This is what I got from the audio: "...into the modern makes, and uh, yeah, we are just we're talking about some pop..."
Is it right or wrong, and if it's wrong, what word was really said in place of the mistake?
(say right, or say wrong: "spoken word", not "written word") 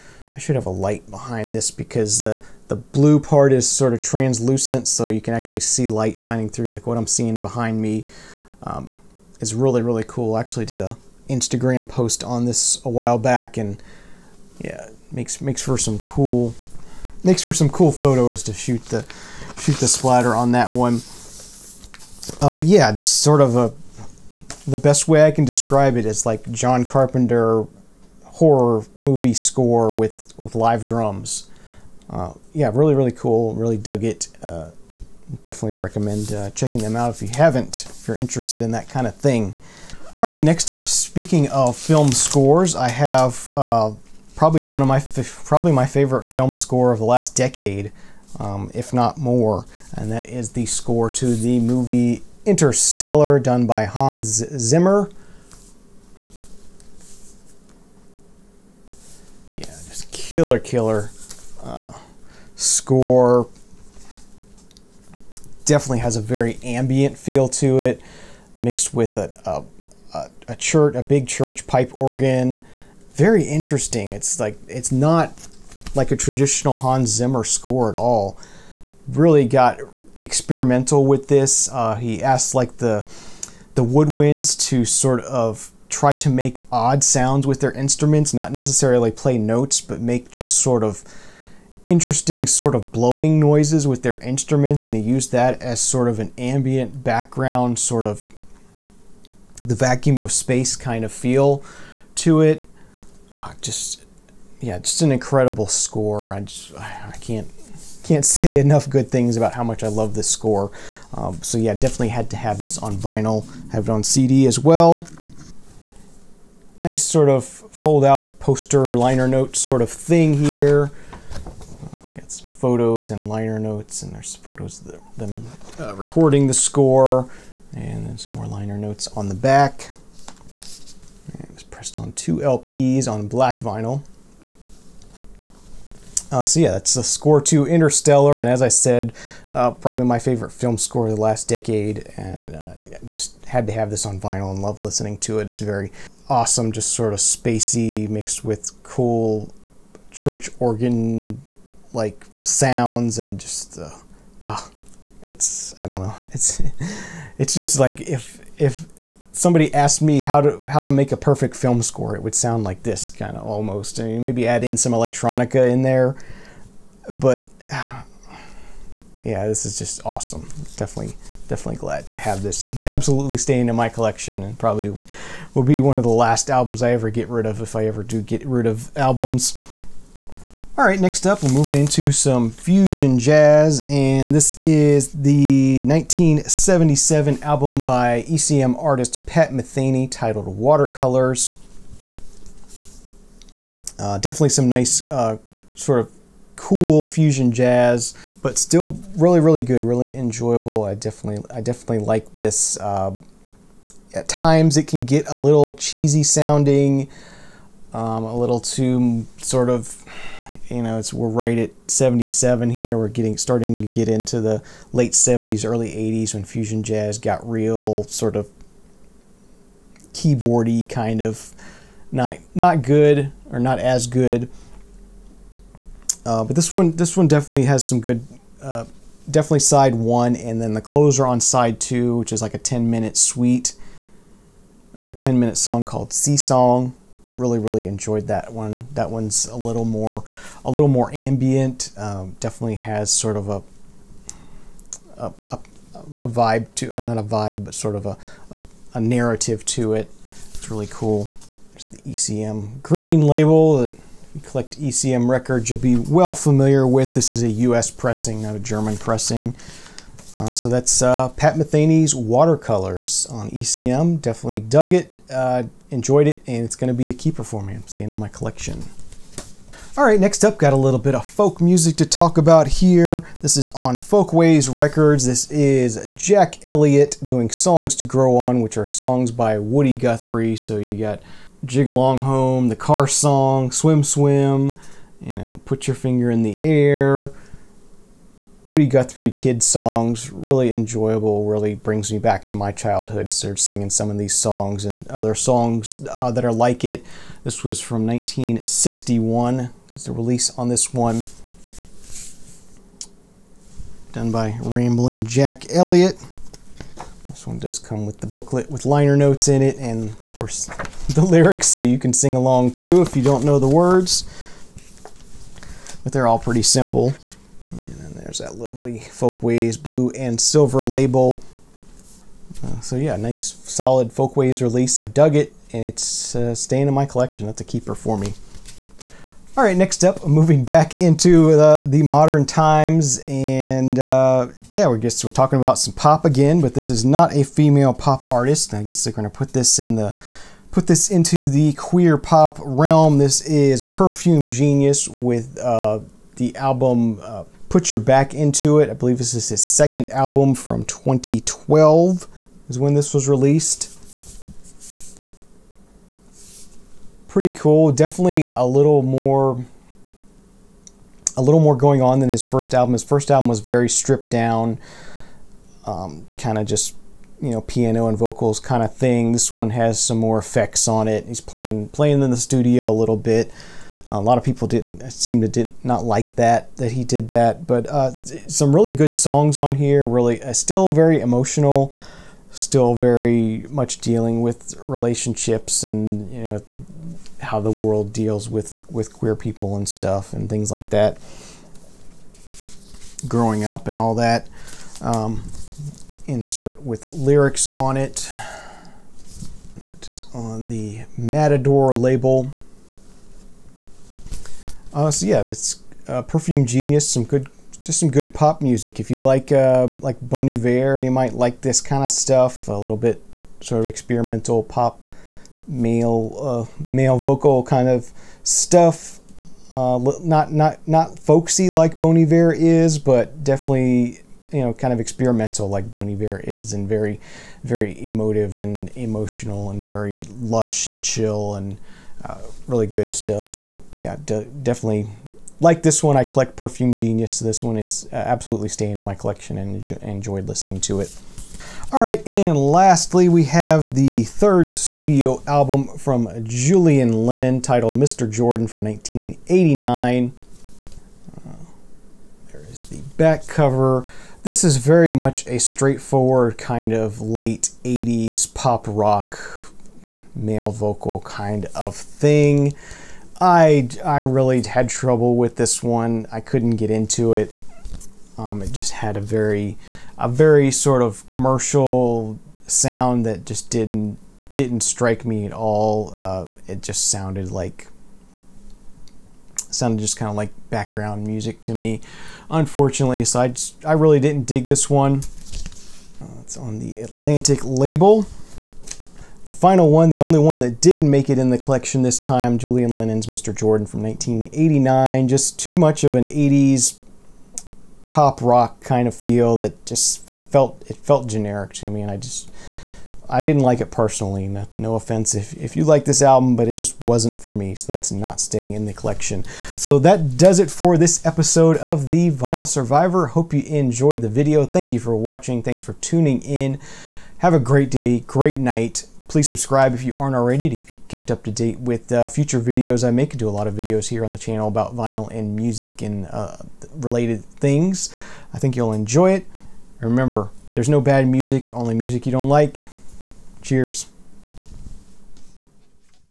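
wrong: "times", not "makes".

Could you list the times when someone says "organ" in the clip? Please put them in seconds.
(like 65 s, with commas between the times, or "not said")
71 s, 150 s.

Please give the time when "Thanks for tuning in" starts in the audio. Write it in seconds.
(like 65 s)
515 s.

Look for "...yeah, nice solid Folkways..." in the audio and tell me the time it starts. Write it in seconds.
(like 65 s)
322 s.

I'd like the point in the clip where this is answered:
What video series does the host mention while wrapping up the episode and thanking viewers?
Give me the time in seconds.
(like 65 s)
512 s.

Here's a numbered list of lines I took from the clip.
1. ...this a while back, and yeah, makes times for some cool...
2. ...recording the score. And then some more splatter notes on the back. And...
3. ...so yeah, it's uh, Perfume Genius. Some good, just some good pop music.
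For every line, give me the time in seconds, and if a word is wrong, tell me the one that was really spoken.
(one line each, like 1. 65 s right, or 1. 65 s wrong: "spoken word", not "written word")
1. 12 s wrong: "makes", not "times"
2. 125 s wrong: "liner", not "splatter"
3. 405 s right.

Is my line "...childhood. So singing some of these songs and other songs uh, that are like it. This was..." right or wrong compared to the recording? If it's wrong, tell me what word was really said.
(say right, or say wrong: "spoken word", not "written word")
right.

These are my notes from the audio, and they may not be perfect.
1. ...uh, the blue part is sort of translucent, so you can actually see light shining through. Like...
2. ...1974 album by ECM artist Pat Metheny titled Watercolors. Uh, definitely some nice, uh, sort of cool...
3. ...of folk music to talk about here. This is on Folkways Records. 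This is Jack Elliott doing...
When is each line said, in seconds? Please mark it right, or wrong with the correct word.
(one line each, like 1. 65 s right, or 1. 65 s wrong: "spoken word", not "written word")
1. 2 s right
2. 185 s wrong: "1977", not "1974"
3. 271 s right.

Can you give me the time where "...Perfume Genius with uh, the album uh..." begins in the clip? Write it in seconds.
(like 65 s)
343 s.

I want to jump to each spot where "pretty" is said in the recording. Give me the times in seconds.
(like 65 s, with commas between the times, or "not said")
316 s, 357 s.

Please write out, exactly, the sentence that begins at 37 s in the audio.
If you're interested in that kind of thing.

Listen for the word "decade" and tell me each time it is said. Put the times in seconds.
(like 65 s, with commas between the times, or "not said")
47 s, 141 s.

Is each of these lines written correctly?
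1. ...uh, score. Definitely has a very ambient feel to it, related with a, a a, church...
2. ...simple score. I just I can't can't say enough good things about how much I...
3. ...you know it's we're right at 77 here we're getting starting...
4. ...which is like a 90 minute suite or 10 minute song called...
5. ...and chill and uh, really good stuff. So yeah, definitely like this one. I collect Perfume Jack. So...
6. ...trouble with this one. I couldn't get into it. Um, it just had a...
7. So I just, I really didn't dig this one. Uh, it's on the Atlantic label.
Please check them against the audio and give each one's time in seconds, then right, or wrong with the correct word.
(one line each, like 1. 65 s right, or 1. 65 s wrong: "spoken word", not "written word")
1. 61 s wrong: "mixed", not "related"
2. 105 s wrong: "incredible", not "simple"
3. 210 s right
4. 232 s wrong: "10", not "90"
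5. 430 s wrong: "Genius", not "Jack"
6. 464 s right
7. 483 s right.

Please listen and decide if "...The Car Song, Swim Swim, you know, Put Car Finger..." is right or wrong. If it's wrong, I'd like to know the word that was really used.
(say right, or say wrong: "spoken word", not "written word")
wrong: "Your", not "Car".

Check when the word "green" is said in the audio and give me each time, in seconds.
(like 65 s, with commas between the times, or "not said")
252 s.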